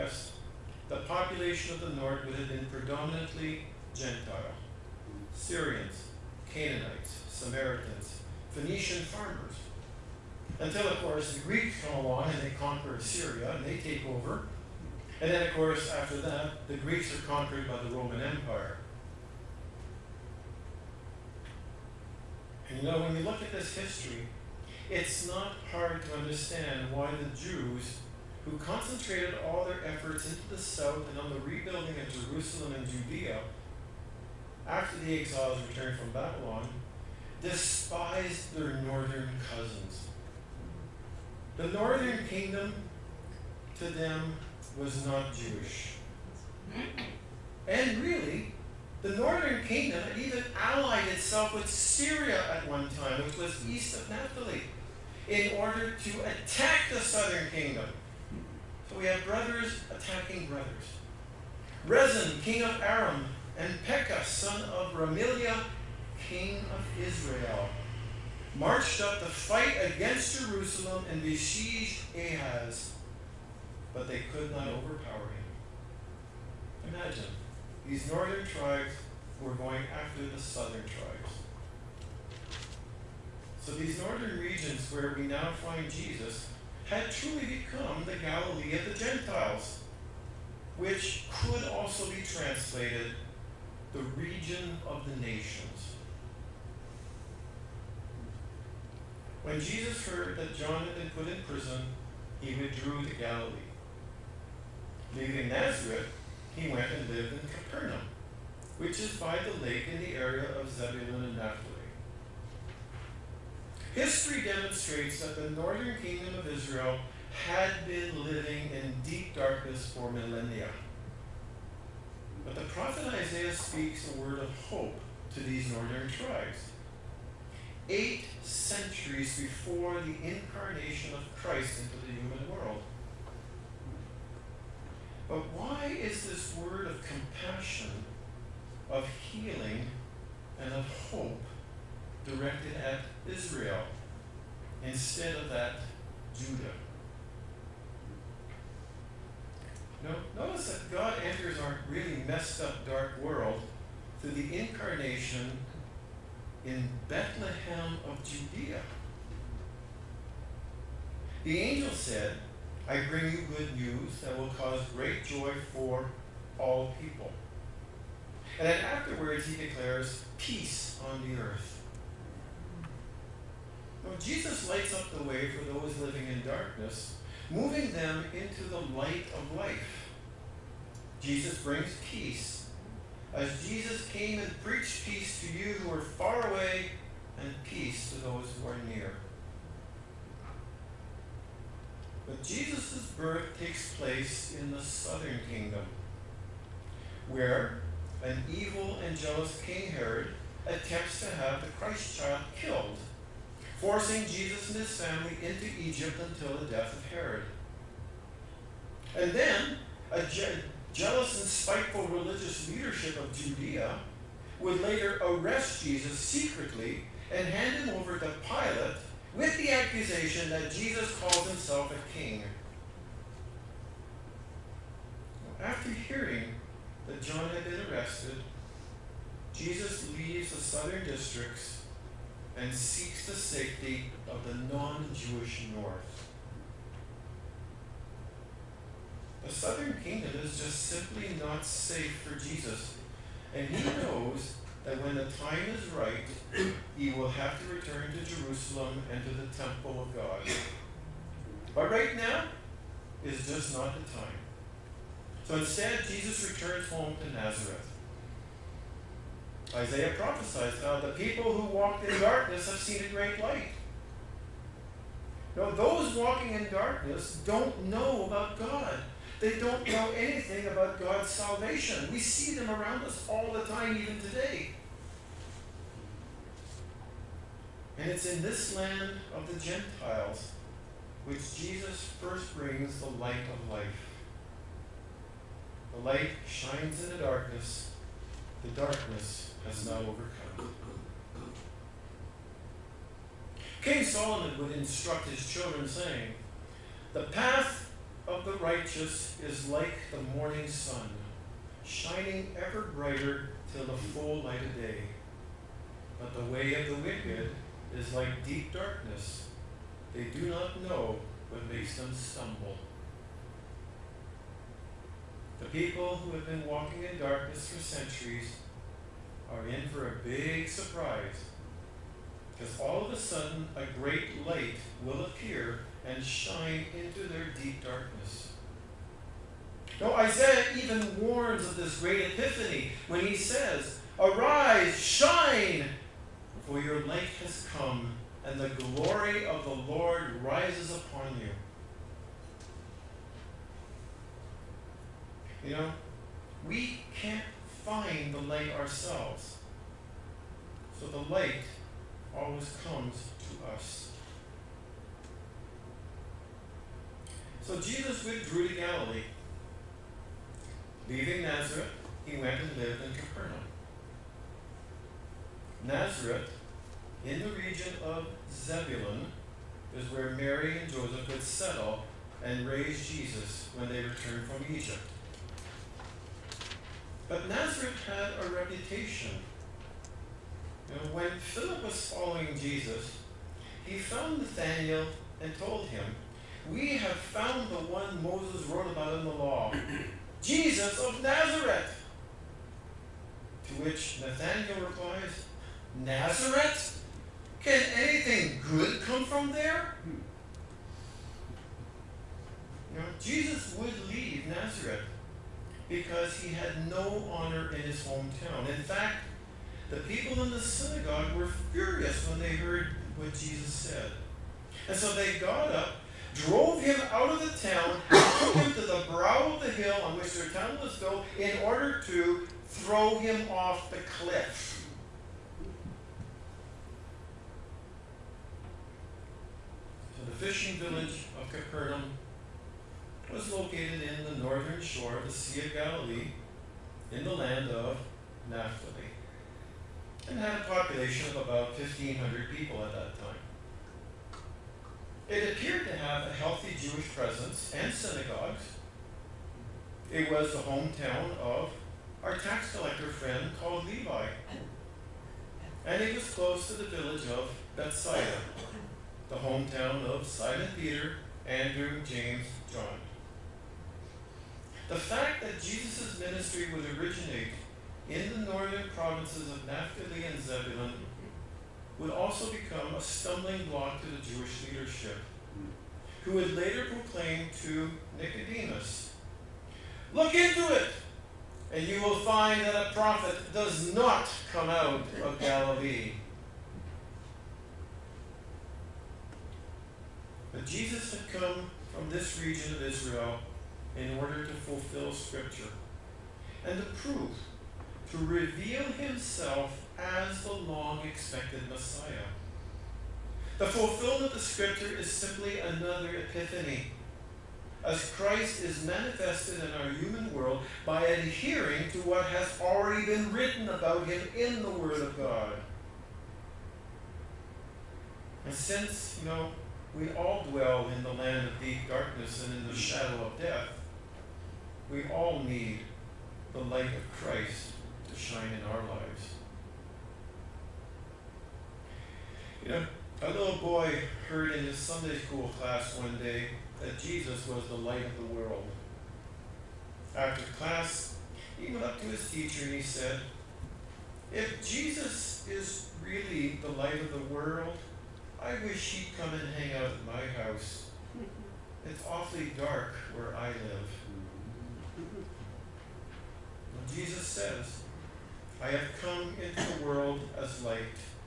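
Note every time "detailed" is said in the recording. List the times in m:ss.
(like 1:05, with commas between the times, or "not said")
not said.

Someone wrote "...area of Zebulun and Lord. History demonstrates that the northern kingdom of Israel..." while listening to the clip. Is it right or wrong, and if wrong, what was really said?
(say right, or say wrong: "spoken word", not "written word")
wrong: "Naphtali", not "Lord".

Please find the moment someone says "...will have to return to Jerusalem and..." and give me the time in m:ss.
4:07.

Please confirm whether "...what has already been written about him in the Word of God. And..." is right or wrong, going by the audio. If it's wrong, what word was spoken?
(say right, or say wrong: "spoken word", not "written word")
right.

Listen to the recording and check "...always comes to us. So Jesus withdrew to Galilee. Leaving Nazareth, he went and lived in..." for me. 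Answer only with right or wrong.
right.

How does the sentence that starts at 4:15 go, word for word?
So instead, Jesus returns home to Nazareth.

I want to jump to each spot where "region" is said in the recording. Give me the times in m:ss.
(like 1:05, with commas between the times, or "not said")
1:24, 1:33, 6:07, 8:12.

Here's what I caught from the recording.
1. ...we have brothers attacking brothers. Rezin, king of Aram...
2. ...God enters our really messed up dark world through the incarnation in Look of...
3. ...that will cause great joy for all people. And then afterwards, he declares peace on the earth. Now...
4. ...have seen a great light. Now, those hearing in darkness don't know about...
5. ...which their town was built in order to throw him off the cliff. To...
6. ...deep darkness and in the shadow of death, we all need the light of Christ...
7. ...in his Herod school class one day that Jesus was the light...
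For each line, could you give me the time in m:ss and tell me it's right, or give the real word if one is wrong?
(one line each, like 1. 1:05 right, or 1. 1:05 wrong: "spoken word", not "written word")
1. 0:58 right
2. 2:30 wrong: "Bethlehem", not "Look"
3. 2:44 right
4. 4:22 wrong: "walking", not "hearing"
5. 7:00 right
6. 8:41 right
7. 8:54 wrong: "Sunday", not "Herod".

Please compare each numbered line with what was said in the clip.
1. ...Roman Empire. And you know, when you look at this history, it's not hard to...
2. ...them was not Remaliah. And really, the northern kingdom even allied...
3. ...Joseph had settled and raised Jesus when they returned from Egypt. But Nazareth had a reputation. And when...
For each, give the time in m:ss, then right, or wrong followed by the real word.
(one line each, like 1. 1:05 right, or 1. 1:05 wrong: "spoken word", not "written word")
1. 0:17 right
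2. 0:43 wrong: "Jewish", not "Remaliah"
3. 6:10 right.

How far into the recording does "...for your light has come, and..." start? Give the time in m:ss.
5:36.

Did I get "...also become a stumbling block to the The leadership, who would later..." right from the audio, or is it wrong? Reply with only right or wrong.
wrong.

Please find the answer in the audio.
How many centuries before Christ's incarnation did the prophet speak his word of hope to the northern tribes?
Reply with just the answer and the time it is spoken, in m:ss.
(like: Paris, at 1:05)
8, at 2:07.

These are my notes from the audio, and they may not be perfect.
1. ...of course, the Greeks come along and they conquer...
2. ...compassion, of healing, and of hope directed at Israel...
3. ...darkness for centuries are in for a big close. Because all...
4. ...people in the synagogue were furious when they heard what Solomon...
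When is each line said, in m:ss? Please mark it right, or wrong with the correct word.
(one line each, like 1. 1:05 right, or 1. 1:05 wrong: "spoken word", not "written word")
1. 0:10 right
2. 2:17 right
3. 5:17 wrong: "surprise", not "close"
4. 6:49 wrong: "Jesus", not "Solomon".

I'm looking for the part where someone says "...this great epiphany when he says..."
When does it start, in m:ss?
5:31.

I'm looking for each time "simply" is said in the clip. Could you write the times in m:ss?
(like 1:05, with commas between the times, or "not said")
4:00, 8:25.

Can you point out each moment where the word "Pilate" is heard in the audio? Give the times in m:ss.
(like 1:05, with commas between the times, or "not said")
3:38.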